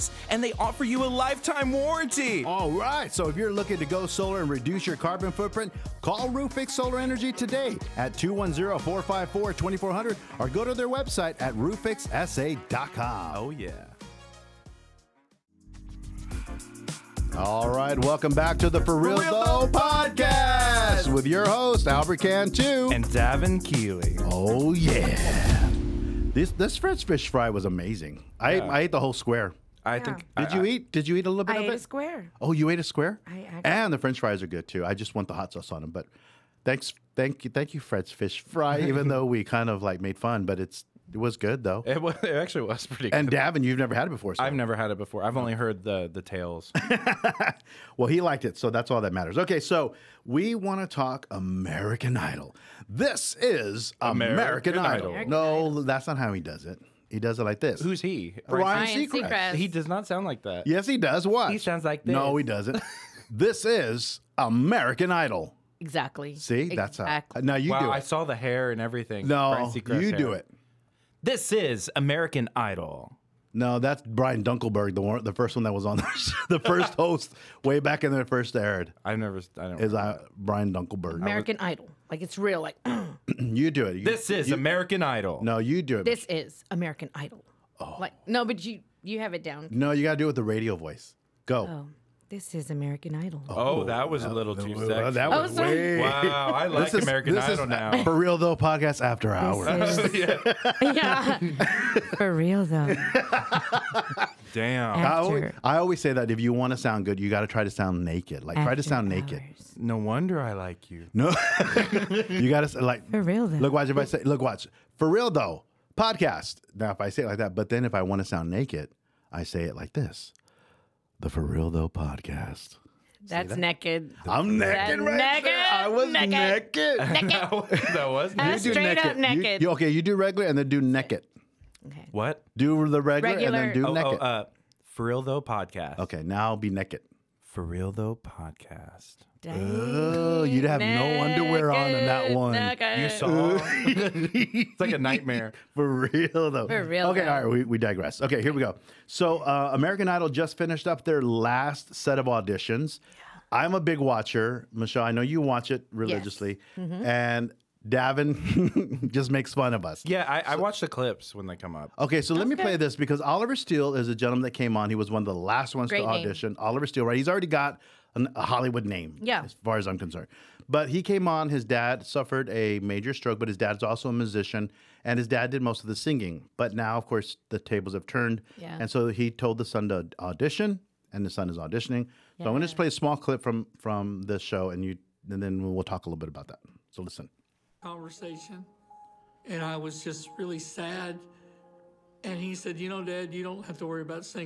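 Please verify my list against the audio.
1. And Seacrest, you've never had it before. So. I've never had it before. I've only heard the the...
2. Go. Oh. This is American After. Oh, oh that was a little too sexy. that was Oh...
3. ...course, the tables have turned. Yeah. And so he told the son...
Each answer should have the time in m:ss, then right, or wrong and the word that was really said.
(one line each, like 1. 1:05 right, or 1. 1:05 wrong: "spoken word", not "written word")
1. 0:43 wrong: "Davin", not "Seacrest"
2. 1:31 wrong: "Idol", not "After"
3. 2:57 right.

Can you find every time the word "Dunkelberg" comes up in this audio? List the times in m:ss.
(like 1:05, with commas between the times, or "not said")
1:14, 1:20.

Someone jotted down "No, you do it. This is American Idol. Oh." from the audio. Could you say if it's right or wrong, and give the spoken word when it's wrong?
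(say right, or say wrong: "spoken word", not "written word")
right.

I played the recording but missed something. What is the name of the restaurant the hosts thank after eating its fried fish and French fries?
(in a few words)
Fred's Fish Fry.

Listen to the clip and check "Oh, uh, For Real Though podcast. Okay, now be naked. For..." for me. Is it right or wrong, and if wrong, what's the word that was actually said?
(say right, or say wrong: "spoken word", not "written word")
right.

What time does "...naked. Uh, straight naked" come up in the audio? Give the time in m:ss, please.
2:08.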